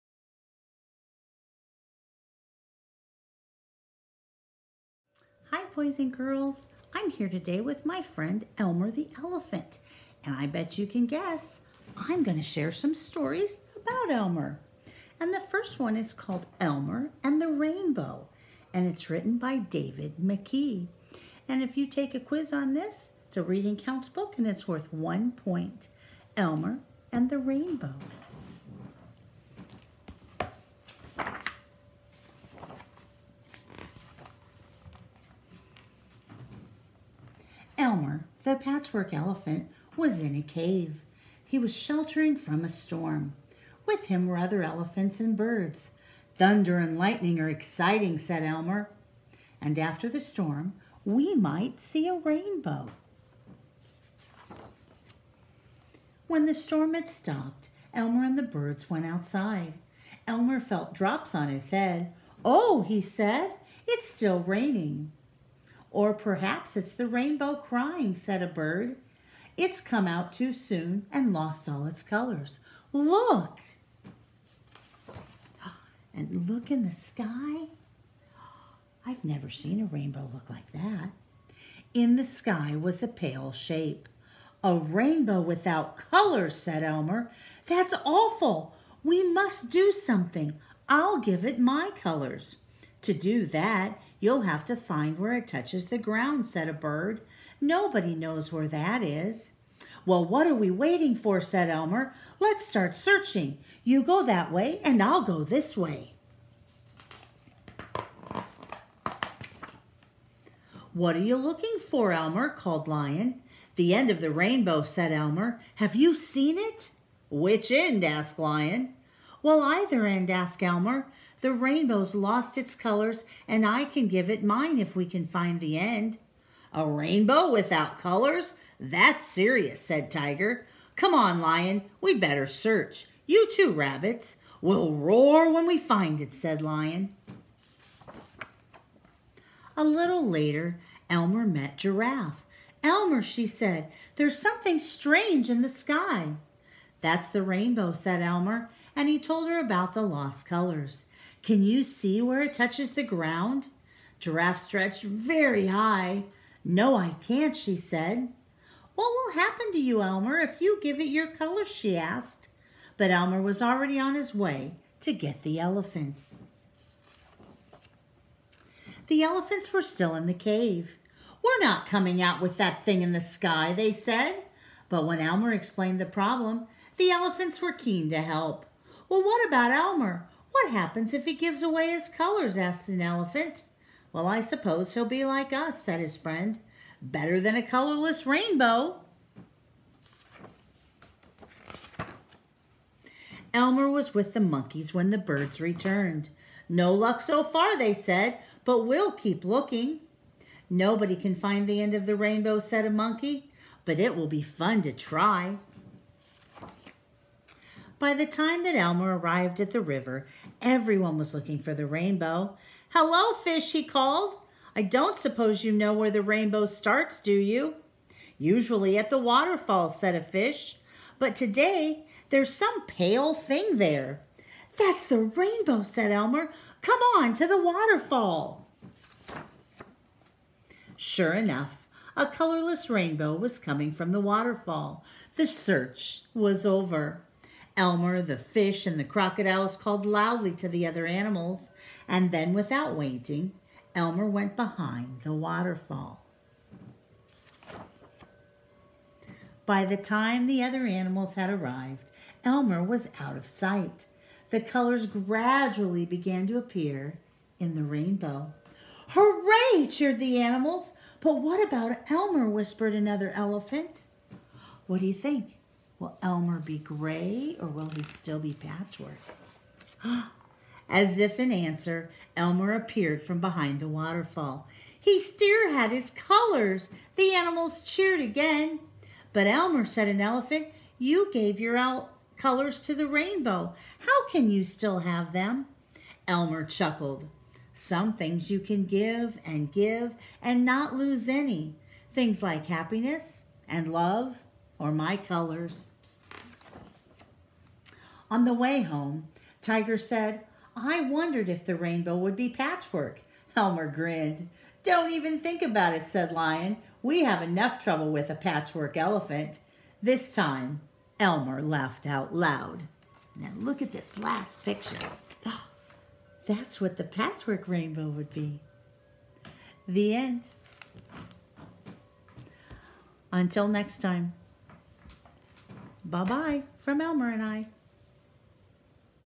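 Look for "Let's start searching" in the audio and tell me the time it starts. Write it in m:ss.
1:42.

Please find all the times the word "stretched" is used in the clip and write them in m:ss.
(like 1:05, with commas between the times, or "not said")
2:34.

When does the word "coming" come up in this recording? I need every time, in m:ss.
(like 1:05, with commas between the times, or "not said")
2:51, 3:53.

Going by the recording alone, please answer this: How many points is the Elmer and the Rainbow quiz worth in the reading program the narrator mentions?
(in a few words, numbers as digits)
1.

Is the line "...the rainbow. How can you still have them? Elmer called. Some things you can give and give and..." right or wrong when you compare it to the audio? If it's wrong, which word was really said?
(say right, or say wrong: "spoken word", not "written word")
wrong: "chuckled", not "called".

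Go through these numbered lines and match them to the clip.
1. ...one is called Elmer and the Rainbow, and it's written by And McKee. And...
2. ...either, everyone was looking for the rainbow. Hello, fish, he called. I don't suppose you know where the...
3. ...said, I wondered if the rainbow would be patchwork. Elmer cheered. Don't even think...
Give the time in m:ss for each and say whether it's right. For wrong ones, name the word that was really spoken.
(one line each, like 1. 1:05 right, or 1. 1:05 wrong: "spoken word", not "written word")
1. 0:15 wrong: "David", not "And"
2. 3:29 wrong: "river", not "either"
3. 4:59 wrong: "grinned", not "cheered".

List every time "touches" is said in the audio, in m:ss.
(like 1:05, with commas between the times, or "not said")
1:35, 2:32.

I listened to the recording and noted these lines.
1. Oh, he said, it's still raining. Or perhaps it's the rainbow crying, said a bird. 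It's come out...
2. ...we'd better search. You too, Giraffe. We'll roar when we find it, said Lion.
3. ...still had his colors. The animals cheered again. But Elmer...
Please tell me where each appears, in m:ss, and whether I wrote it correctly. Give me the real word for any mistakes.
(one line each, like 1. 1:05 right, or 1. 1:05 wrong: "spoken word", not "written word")
1. 1:02 right
2. 2:11 wrong: "Rabbits", not "Giraffe"
3. 4:35 right.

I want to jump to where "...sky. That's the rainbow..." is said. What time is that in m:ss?
2:25.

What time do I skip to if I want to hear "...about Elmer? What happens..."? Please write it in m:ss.
2:59.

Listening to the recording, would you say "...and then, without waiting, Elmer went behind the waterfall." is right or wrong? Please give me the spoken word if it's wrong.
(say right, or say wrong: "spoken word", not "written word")
right.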